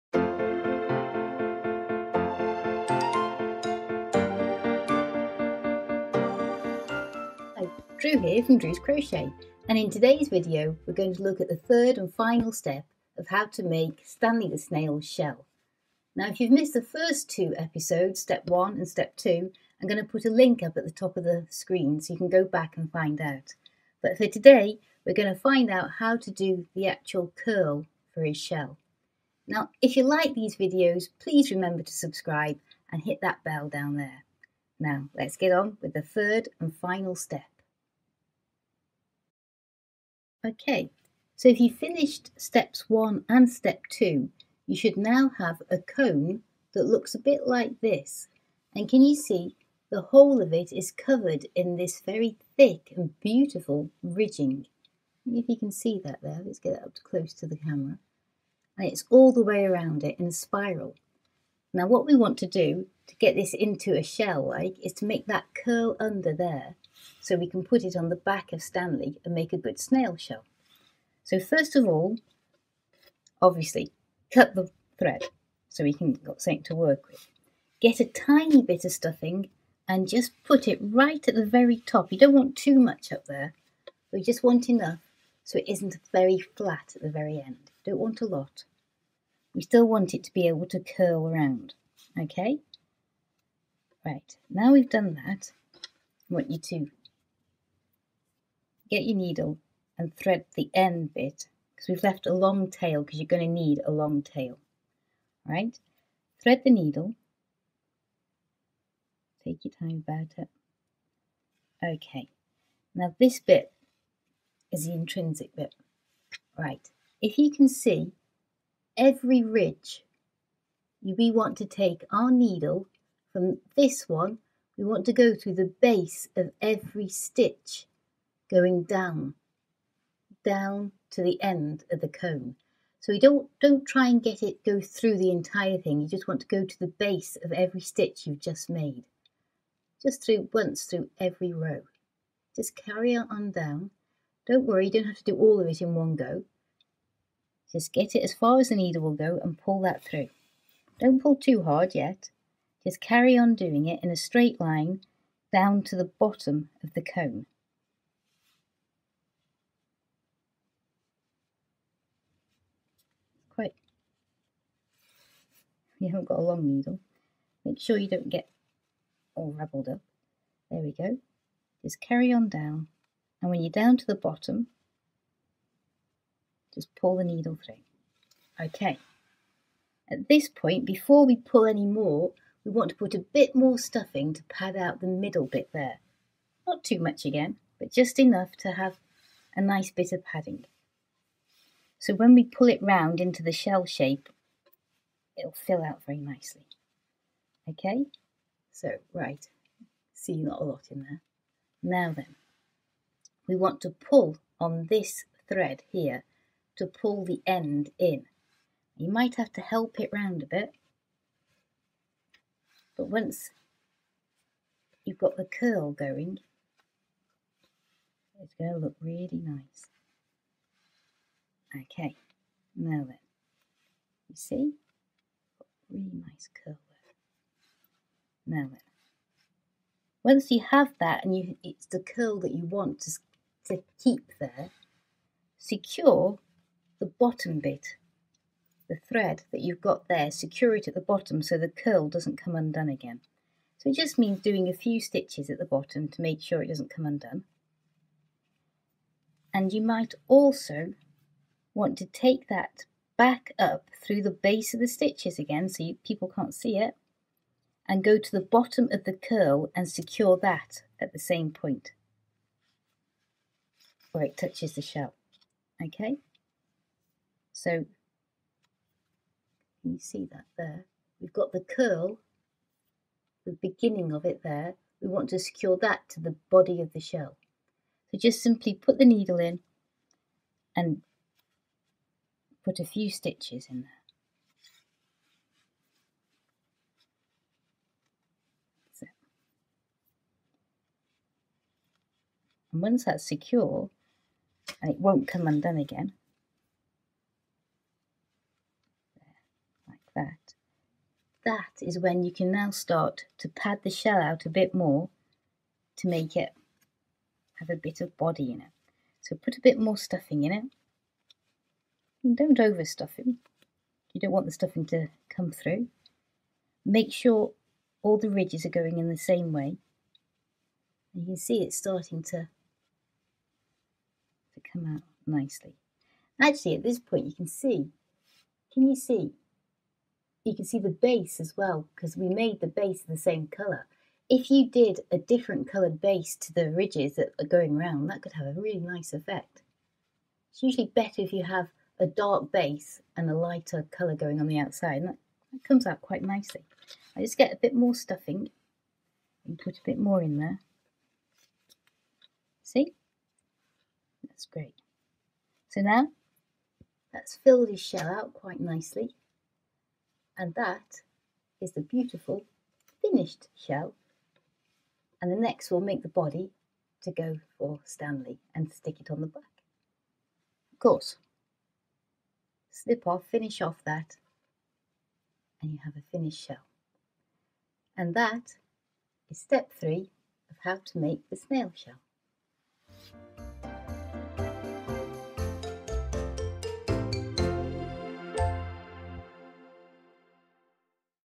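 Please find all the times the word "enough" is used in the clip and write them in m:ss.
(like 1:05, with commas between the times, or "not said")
1:24, 3:08.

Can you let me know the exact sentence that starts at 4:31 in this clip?
We've got the curl, the beginning of it there.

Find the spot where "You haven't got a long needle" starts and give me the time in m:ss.
2:45.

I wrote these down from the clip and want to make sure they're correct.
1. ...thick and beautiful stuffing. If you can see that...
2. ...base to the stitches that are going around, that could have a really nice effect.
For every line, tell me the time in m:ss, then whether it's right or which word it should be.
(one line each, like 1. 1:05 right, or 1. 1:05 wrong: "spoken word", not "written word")
1. 0:52 wrong: "ridging", not "stuffing"
2. 5:36 wrong: "ridges", not "stitches".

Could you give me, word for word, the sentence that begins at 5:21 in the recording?
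And you can see it's starting to, to come out nicely.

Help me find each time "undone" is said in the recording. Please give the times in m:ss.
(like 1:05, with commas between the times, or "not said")
4:02, 4:07, 4:55.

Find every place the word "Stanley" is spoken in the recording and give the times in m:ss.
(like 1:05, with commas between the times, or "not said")
0:14, 1:08, 6:07.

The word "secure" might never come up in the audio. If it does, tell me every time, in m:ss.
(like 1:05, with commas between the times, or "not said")
3:55, 4:00, 4:19, 4:35, 4:53.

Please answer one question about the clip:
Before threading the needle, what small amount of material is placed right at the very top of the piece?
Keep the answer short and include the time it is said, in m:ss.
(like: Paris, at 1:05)
A tiny bit of stuffing, at 1:18.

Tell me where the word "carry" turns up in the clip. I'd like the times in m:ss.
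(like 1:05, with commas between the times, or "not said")
2:22, 2:32, 2:52.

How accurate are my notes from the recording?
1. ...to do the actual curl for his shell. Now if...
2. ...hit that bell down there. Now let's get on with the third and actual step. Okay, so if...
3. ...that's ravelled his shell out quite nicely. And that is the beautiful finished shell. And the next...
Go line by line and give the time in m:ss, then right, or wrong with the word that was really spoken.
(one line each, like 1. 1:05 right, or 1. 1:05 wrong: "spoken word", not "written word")
1. 0:26 right
2. 0:33 wrong: "final", not "actual"
3. 5:57 wrong: "filled", not "ravelled".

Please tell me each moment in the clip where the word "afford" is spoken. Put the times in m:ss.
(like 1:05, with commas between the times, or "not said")
not said.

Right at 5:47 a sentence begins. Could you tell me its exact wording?
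I just get a bit more stuffing and put a bit more in there.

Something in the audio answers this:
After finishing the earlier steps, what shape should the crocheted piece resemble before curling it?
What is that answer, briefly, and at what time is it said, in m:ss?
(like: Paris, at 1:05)
A cone, at 0:45.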